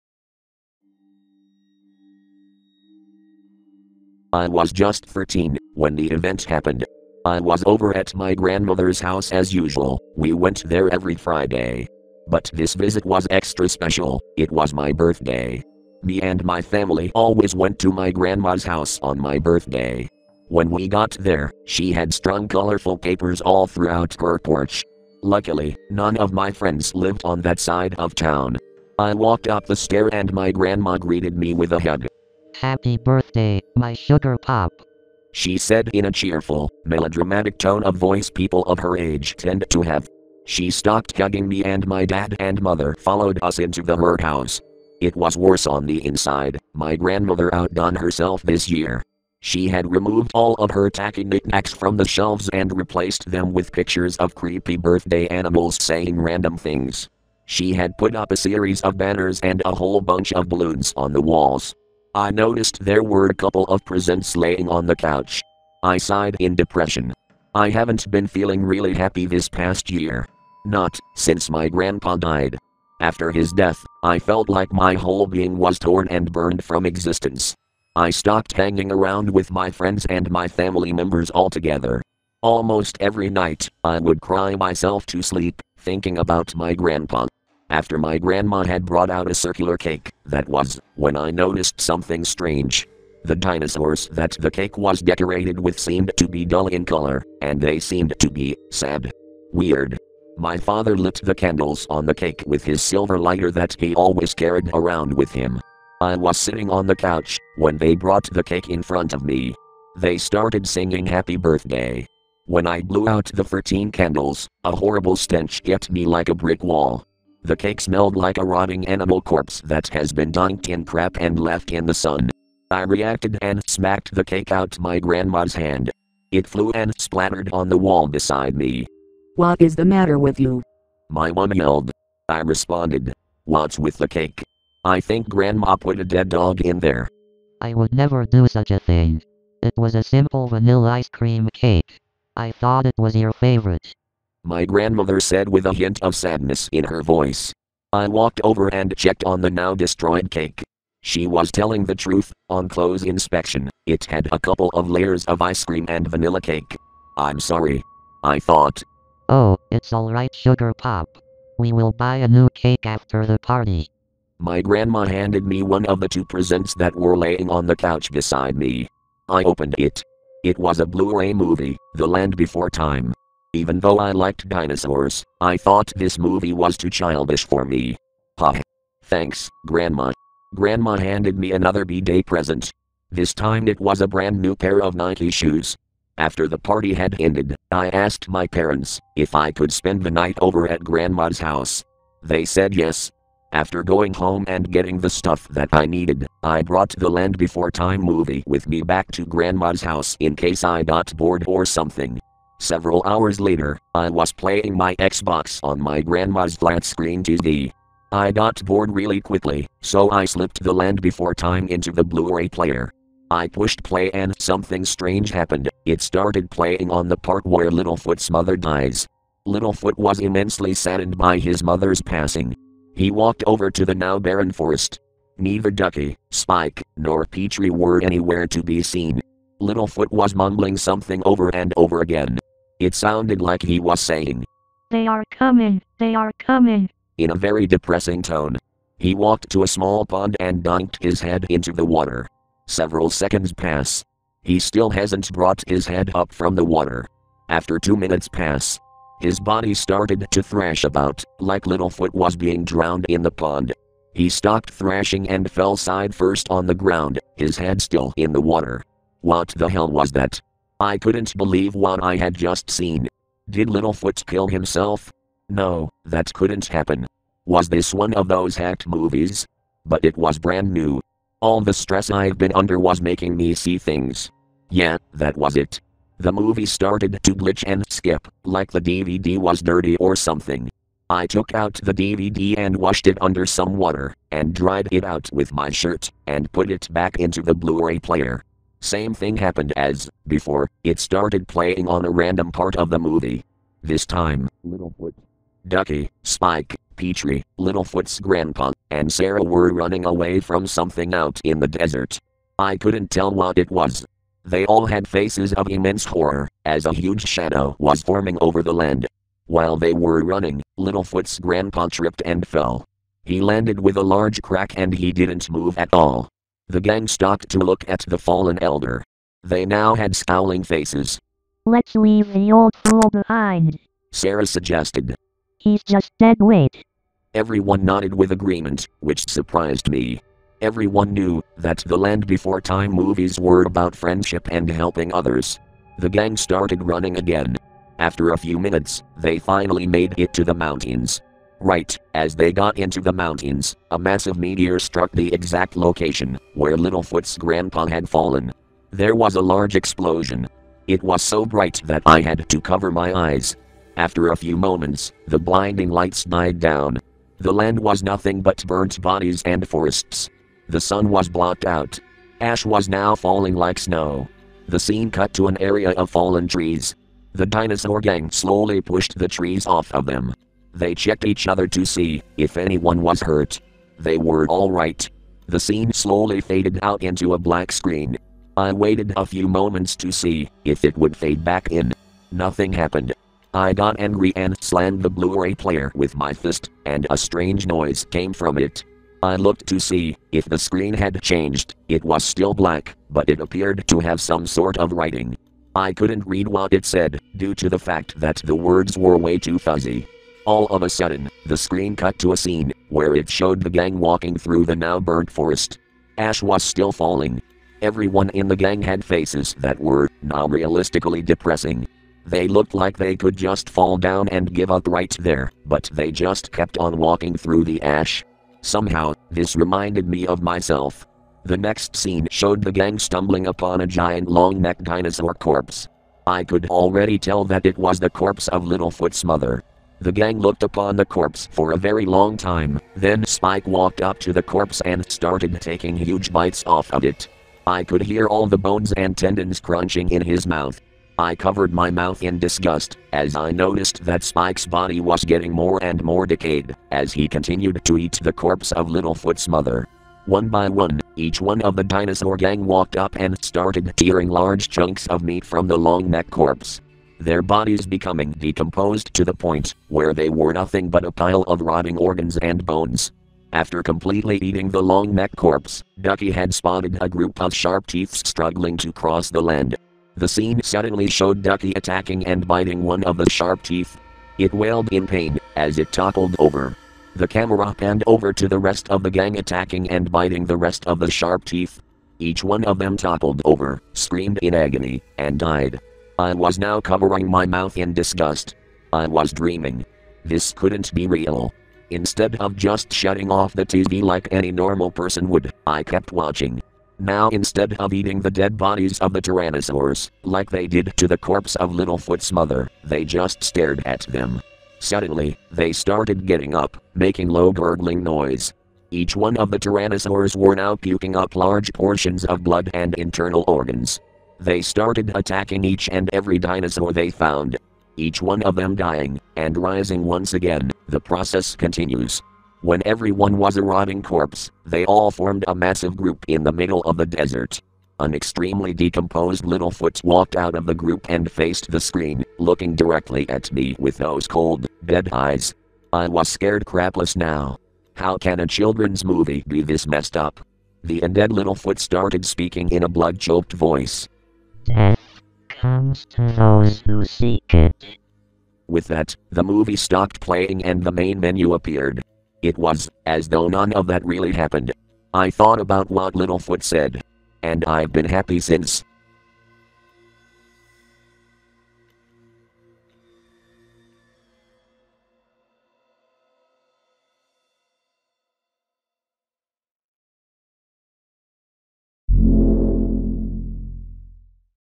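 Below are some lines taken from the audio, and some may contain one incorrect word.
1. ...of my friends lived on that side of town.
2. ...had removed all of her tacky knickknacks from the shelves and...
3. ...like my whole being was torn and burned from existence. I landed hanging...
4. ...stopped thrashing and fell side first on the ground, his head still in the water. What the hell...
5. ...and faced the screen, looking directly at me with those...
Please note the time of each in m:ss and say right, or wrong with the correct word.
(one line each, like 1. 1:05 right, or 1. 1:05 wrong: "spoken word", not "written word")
1. 0:26 right
2. 0:49 right
3. 1:14 wrong: "stopped", not "landed"
4. 4:14 right
5. 8:51 right.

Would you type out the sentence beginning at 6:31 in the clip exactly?
It was still black, but it appeared to have some sort of writing.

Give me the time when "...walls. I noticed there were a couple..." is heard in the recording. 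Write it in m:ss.
1:01.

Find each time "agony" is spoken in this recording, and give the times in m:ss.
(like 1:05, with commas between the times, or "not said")
8:04.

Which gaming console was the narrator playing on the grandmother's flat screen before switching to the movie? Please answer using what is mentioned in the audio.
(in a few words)
Xbox.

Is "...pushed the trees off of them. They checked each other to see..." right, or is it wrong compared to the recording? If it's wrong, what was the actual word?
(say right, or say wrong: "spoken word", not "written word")
right.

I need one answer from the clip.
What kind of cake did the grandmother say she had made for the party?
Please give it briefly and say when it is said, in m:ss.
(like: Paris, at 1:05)
Vanilla ice cream cake, at 2:20.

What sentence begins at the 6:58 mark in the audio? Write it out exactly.
Somehow, this reminded me of myself.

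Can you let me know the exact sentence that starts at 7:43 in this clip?
After completely eating the long neck corpse, Ducky had spotted a group of sharp teeth struggling to cross the land.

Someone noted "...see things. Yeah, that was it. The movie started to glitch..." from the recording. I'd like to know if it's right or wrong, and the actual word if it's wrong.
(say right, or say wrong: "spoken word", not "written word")
right.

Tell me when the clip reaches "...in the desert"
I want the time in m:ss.
5:01.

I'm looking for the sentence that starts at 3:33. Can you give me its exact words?
I pushed play and something strange happened.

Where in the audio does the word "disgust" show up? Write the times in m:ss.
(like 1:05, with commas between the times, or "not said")
7:22, 8:07.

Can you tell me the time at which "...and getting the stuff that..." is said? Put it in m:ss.
3:14.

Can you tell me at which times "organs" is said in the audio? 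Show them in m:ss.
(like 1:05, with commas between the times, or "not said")
7:41, 8:33.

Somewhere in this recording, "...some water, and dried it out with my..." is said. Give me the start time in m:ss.
4:43.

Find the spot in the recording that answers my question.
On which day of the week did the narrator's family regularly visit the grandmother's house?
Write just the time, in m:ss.
0:11.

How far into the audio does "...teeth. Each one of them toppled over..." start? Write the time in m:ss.
8:01.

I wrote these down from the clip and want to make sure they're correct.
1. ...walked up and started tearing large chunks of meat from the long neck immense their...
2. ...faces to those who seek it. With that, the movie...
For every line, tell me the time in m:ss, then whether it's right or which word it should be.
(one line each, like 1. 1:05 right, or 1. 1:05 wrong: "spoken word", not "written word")
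1. 7:32 wrong: "corpse", not "immense"
2. 9:05 wrong: "comes", not "faces".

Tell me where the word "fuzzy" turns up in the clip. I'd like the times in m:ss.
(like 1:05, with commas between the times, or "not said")
6:39.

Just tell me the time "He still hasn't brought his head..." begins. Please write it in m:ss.
4:04.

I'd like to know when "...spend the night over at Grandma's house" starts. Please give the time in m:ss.
3:09.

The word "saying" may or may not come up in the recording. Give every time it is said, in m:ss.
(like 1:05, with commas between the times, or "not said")
0:55, 3:53.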